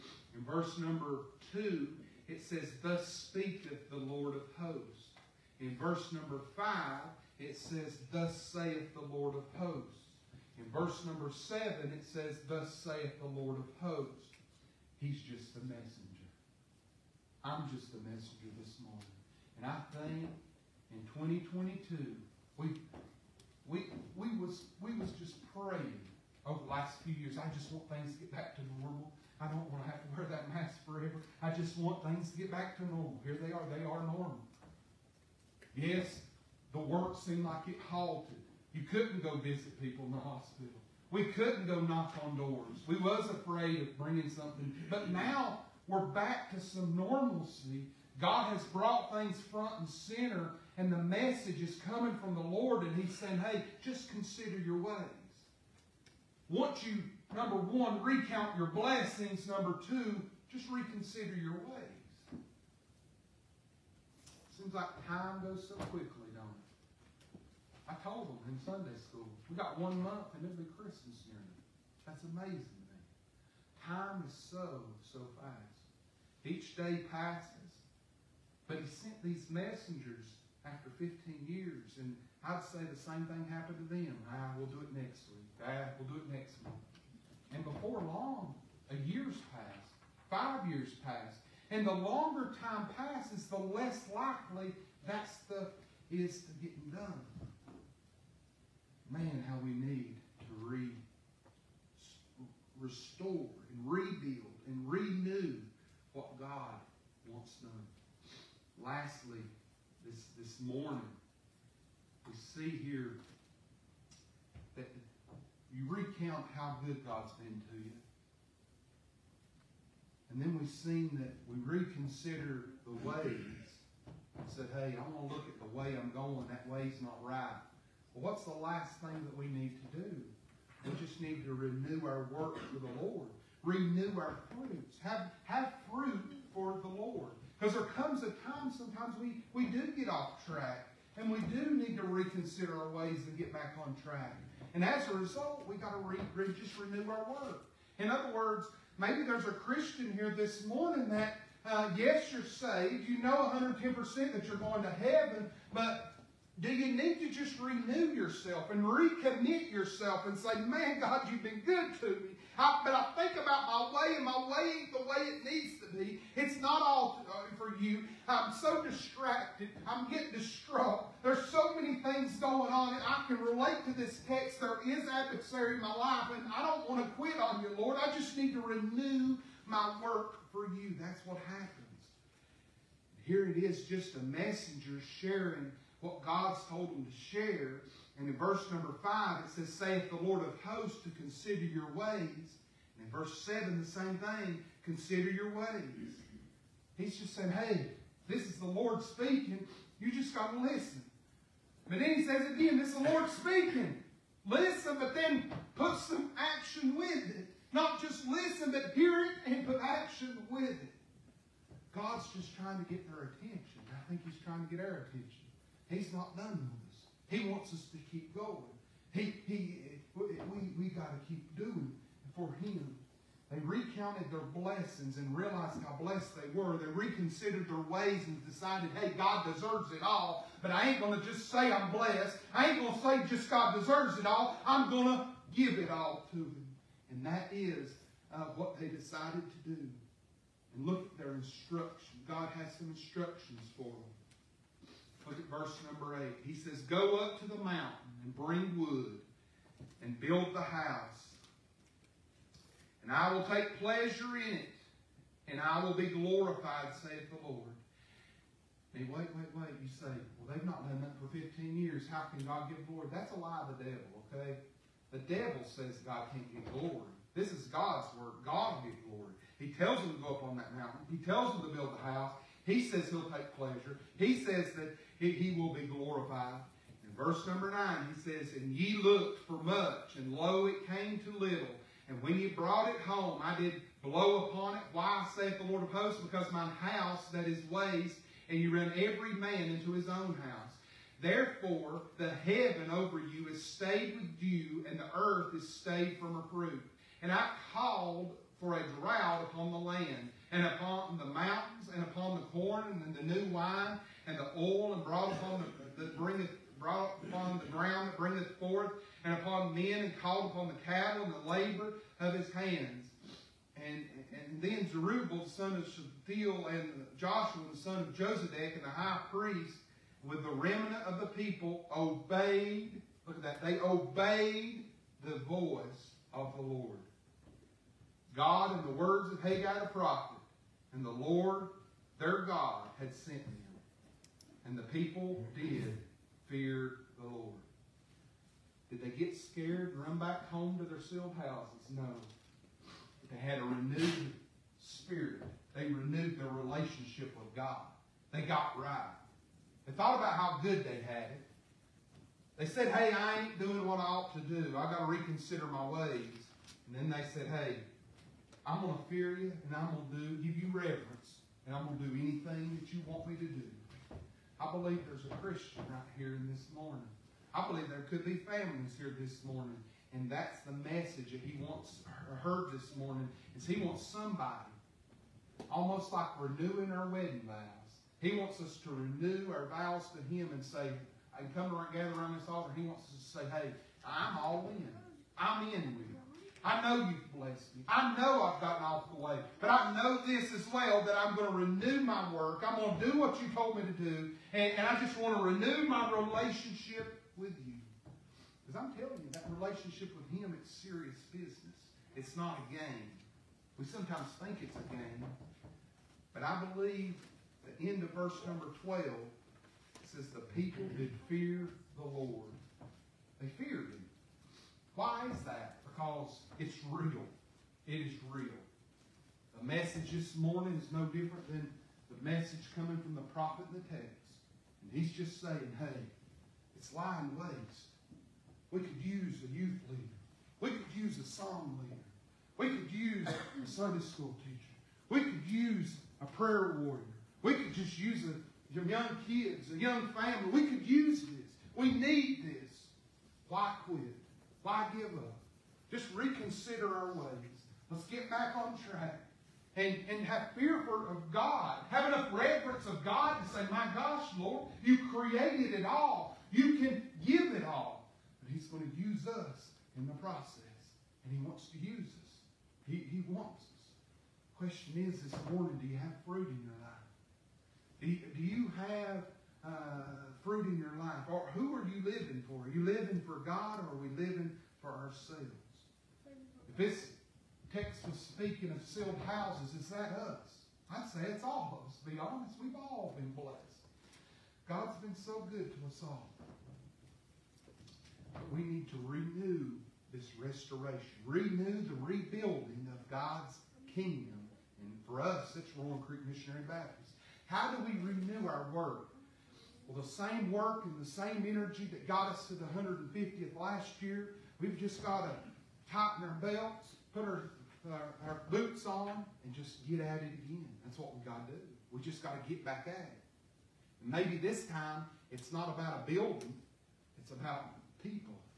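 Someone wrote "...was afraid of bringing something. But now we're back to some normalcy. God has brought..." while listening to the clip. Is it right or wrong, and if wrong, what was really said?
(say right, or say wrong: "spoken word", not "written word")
right.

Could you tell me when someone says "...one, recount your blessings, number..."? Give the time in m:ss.
0:57.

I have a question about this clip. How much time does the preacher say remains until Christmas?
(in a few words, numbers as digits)
1 month.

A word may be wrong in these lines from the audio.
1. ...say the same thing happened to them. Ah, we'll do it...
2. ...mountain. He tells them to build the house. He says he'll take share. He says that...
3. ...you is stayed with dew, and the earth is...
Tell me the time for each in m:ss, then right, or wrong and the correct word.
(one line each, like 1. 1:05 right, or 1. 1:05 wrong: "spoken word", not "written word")
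1. 1:22 right
2. 4:30 wrong: "pleasure", not "share"
3. 4:53 right.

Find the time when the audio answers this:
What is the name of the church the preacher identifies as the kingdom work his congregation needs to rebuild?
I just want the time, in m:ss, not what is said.
8:15.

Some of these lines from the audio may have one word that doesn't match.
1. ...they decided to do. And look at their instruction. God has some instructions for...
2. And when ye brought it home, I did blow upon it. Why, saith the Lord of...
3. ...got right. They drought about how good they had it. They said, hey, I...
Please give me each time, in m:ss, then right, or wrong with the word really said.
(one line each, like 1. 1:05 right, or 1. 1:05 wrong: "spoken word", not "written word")
1. 3:58 right
2. 4:42 right
3. 5:48 wrong: "thought", not "drought".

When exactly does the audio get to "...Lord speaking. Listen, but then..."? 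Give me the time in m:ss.
3:23.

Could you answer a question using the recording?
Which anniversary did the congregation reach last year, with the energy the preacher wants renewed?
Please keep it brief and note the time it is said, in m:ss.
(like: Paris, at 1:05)
150th, at 8:22.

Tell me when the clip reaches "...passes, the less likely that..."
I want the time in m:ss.
1:32.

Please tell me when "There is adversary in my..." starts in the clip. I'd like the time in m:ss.
2:54.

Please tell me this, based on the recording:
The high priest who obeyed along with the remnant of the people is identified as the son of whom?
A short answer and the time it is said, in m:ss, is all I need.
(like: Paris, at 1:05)
Josedek, at 5:18.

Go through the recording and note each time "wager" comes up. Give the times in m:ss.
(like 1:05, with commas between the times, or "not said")
not said.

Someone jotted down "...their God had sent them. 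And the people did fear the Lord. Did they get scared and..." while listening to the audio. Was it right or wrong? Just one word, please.
right.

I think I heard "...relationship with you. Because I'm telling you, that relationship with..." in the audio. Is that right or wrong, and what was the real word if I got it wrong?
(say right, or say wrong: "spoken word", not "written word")
right.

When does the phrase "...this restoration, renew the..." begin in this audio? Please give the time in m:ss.
8:10.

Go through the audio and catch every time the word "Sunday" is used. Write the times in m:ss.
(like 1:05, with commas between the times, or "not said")
1:08, 7:13.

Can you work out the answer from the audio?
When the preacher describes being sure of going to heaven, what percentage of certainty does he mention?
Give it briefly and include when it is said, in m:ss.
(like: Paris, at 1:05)
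110%, at 2:33.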